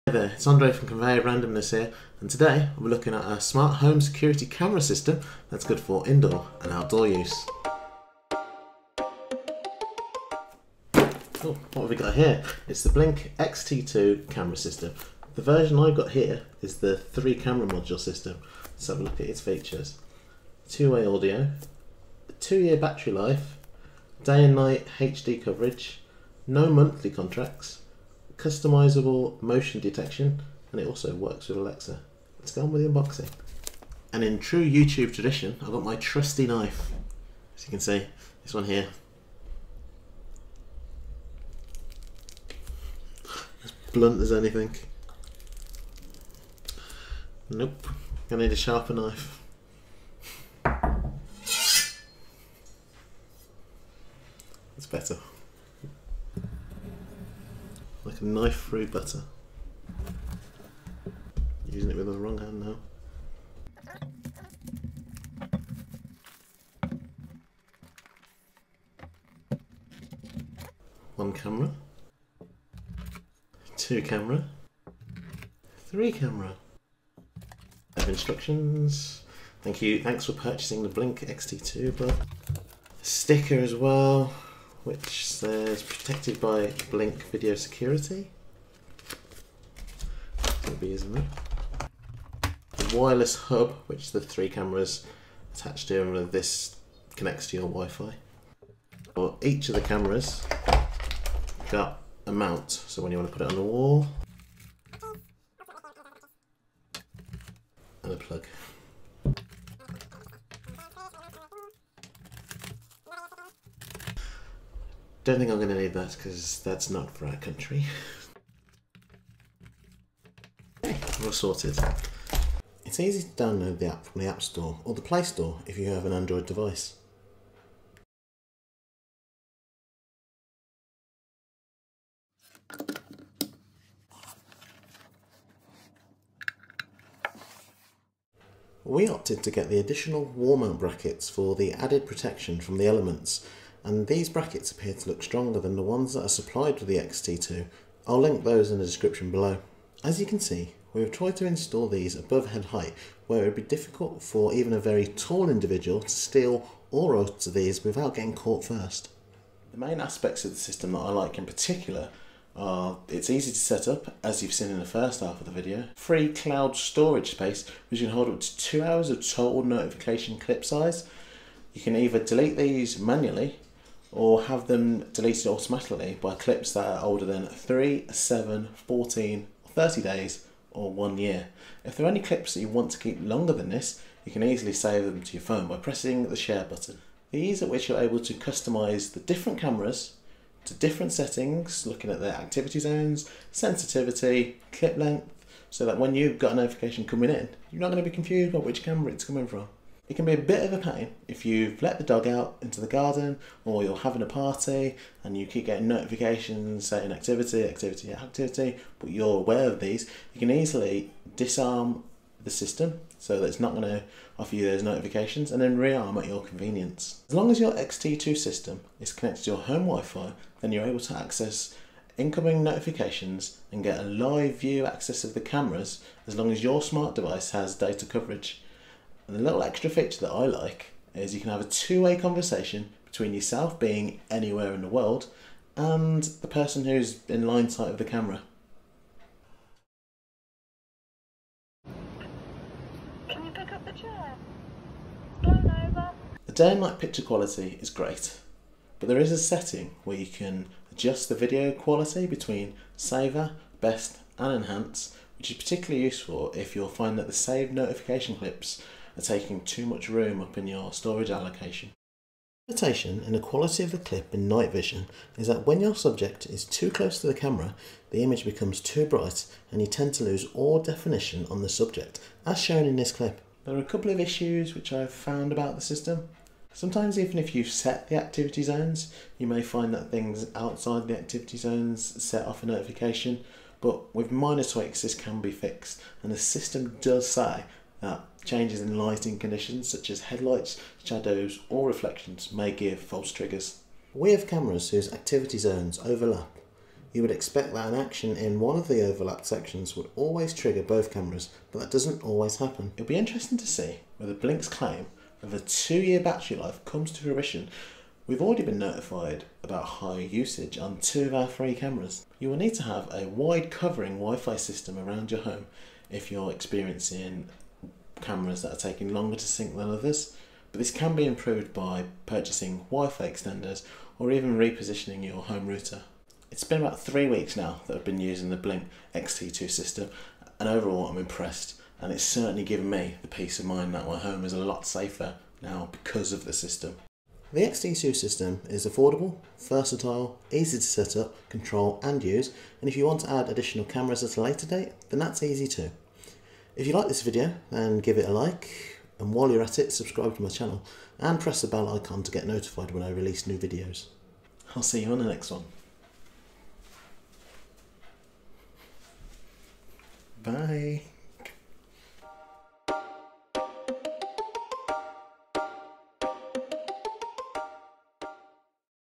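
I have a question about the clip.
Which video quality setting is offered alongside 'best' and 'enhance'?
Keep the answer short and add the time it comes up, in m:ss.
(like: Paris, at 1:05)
Saver, at 4:12.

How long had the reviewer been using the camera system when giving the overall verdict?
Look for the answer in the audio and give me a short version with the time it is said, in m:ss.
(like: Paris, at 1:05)
3 weeks, at 5:26.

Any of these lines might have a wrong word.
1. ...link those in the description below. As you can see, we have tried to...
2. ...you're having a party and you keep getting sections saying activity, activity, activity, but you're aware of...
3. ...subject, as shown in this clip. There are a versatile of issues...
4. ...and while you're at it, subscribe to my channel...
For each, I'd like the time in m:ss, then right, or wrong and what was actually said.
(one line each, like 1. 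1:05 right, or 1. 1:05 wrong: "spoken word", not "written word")
1. 2:28 right
2. 3:23 wrong: "notifications", not "sections"
3. 4:31 wrong: "couple", not "versatile"
4. 5:49 right.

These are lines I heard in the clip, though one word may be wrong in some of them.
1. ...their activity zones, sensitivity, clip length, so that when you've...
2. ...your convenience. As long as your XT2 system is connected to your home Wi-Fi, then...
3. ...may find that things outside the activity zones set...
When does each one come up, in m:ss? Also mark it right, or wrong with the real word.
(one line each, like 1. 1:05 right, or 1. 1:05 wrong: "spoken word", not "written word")
1. 3:12 right
2. 3:36 right
3. 4:39 right.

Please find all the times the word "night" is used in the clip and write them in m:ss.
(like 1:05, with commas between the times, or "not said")
0:24, 4:06, 4:24.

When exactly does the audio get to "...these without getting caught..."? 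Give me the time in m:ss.
2:37.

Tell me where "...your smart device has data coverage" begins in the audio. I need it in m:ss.
3:46.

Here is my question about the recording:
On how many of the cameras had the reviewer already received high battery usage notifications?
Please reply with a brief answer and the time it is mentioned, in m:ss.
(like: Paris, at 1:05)
2, at 5:11.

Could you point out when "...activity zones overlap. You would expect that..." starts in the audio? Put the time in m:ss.
4:55.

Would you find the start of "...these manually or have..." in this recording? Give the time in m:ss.
2:52.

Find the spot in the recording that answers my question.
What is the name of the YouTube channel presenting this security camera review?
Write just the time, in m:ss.
0:00.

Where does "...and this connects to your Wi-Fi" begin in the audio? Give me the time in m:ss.
1:36.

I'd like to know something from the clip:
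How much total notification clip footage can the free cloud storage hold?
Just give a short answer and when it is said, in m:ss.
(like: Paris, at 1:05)
2 hours, at 2:48.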